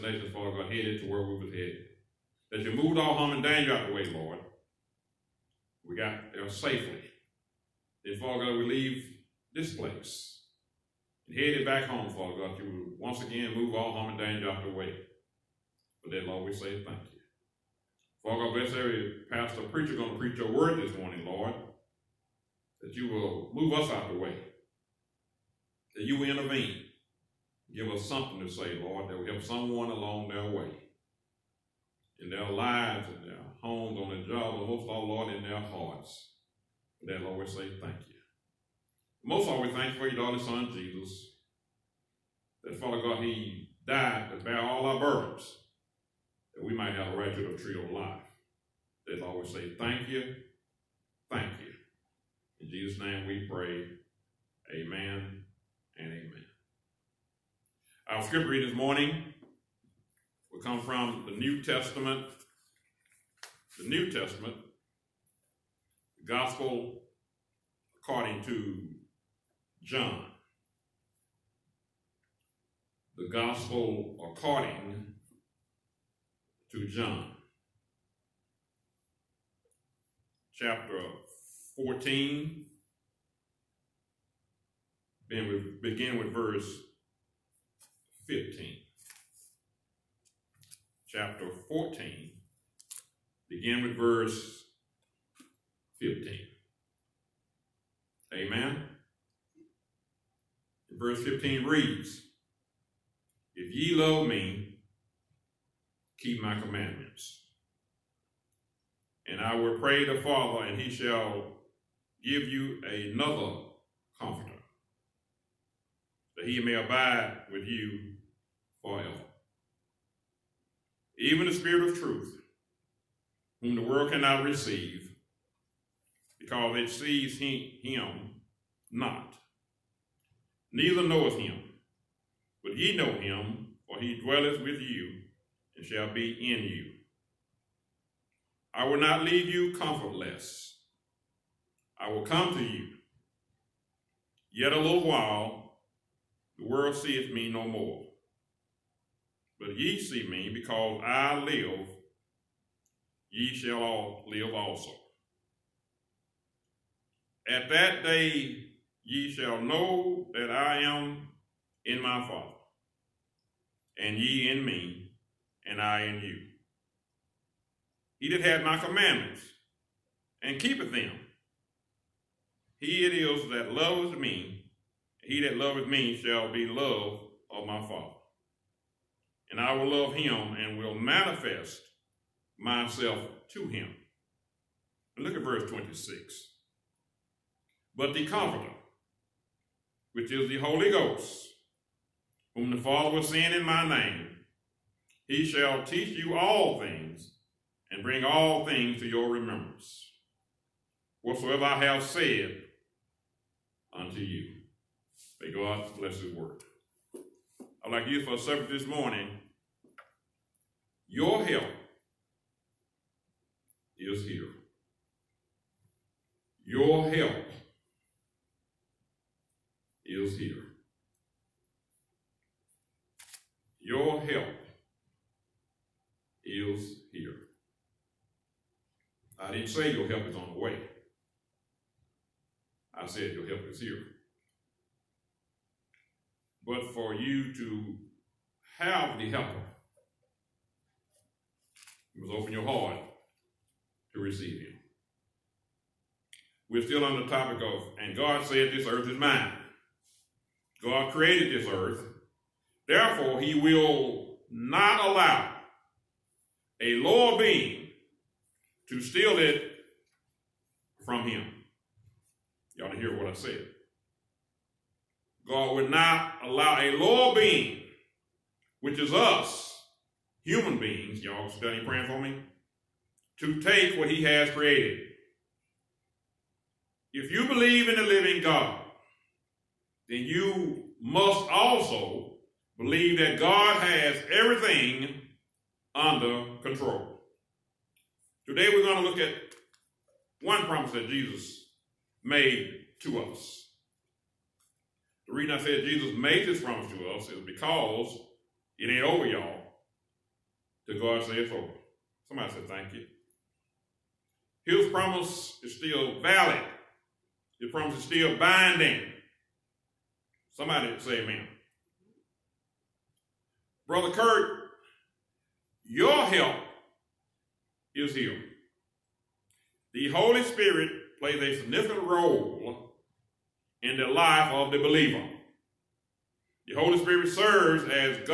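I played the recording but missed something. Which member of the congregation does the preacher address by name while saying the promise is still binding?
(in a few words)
Brother Kurt.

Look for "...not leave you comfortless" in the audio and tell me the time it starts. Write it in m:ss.
2:19.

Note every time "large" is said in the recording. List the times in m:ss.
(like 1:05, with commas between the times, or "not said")
not said.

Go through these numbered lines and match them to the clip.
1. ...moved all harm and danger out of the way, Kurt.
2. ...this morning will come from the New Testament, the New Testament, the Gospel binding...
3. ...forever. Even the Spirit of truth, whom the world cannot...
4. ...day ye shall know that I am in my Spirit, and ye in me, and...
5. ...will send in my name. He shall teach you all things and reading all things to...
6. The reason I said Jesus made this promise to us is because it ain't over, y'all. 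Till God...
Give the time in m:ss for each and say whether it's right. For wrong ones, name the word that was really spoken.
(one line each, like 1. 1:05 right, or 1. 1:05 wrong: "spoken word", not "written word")
1. 0:02 wrong: "Lord", not "Kurt"
2. 0:58 wrong: "according", not "binding"
3. 1:58 right
4. 2:38 wrong: "Father", not "Spirit"
5. 3:13 wrong: "bring", not "reading"
6. 4:55 right.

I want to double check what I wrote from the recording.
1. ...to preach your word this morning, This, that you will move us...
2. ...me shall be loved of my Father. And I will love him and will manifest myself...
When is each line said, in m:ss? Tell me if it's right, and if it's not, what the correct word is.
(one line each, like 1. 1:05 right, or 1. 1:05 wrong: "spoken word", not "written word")
1. 0:20 wrong: "Lord", not "This"
2. 2:55 right.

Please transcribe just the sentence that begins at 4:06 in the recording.
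We're still on the topic of, and God said, This earth is mine.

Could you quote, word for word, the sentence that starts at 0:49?
They always say, thank you, thank you.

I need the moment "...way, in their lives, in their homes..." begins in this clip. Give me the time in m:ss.
0:30.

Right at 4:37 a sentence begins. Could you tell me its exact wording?
If you believe in the living God, then you must also believe that God has everything under control.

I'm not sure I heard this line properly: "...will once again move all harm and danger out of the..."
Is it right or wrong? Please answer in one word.
right.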